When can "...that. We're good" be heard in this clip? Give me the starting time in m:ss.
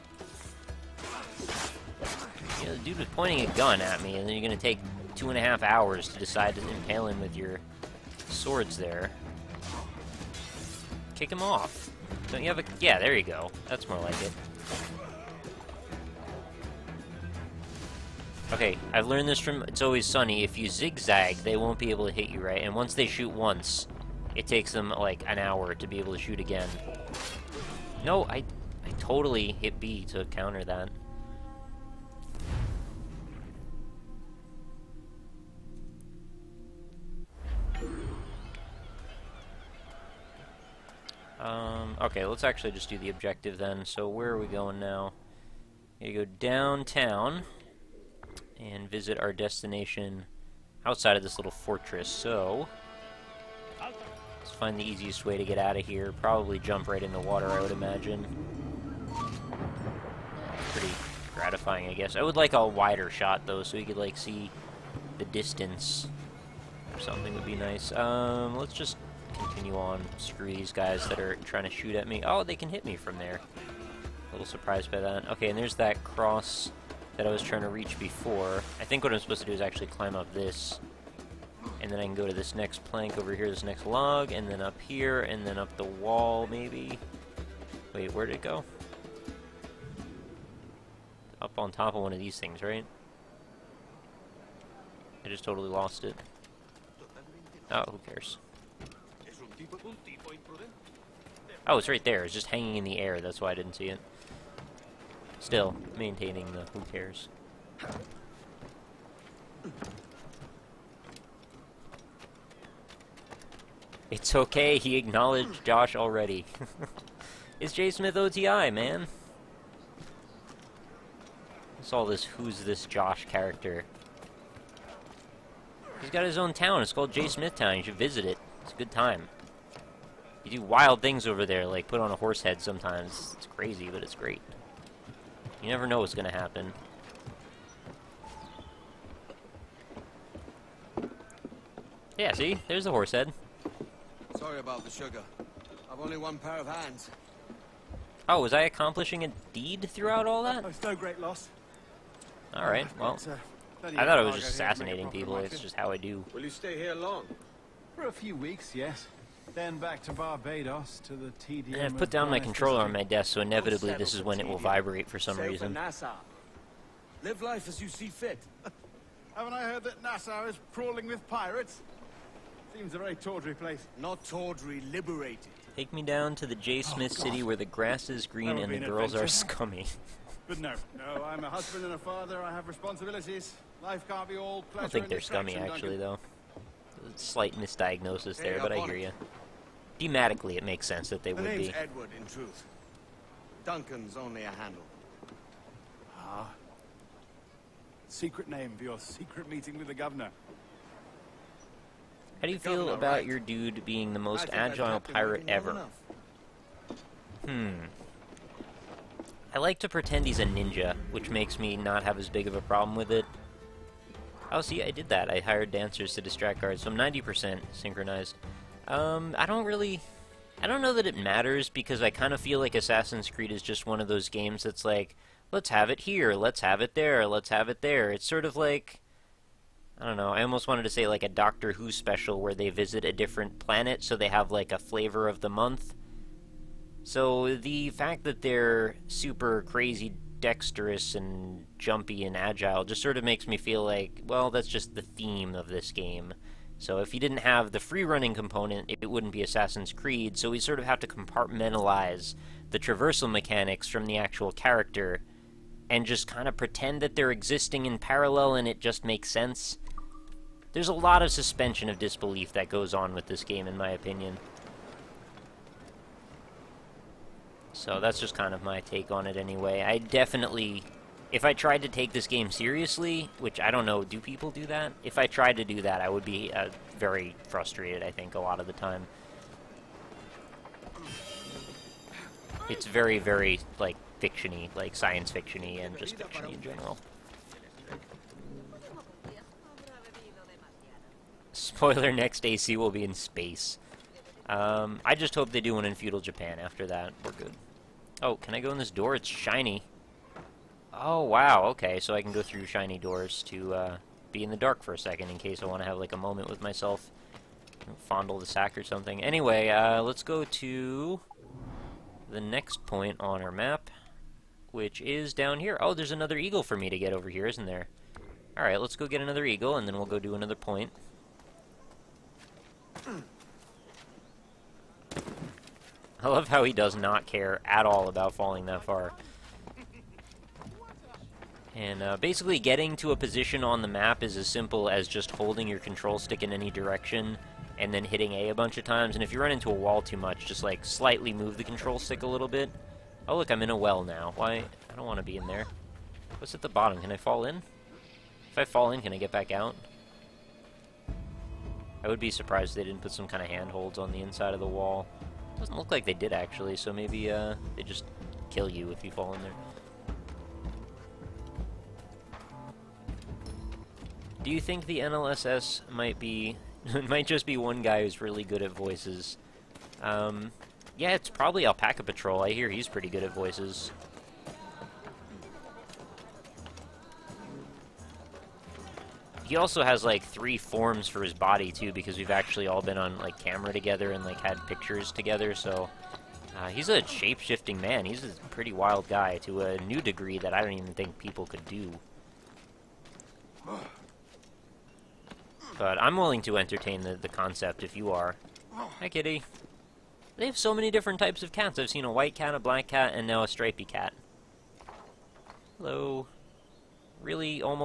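4:56.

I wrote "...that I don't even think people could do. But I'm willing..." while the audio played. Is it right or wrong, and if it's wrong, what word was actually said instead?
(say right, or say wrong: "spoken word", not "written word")
right.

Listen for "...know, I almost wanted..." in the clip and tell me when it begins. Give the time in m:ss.
3:50.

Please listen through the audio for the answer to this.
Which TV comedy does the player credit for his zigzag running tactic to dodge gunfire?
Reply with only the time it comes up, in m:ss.
0:19.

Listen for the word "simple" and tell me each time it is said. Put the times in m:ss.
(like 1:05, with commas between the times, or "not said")
5:34.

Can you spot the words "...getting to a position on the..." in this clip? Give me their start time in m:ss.
5:32.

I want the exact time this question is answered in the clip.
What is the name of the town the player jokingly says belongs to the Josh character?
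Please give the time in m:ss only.
2:07.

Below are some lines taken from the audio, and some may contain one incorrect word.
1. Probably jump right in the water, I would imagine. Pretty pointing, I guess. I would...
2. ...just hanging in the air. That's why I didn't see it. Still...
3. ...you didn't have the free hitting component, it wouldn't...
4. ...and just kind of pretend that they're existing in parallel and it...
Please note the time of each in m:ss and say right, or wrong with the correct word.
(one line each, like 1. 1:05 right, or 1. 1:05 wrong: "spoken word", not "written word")
1. 0:56 wrong: "gratifying", not "pointing"
2. 1:42 right
3. 4:07 wrong: "running", not "hitting"
4. 4:15 right.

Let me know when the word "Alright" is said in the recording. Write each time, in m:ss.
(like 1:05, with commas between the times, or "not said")
2:32, 5:18.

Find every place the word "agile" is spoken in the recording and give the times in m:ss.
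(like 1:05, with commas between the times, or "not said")
3:24, 4:02.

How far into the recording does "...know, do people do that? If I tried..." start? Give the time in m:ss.
4:33.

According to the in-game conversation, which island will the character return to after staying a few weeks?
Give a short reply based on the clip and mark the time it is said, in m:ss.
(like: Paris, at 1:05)
Barbados, at 2:40.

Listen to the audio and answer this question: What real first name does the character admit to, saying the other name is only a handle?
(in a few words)
Edward.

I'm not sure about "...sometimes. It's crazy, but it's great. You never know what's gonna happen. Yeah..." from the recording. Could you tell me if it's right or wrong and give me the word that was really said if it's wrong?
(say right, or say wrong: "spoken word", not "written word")
right.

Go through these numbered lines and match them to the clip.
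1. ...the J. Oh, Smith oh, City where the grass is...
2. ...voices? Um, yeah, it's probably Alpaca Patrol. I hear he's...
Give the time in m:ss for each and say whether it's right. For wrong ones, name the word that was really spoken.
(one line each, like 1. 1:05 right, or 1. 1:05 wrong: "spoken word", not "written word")
1. 2:56 right
2. 6:08 right.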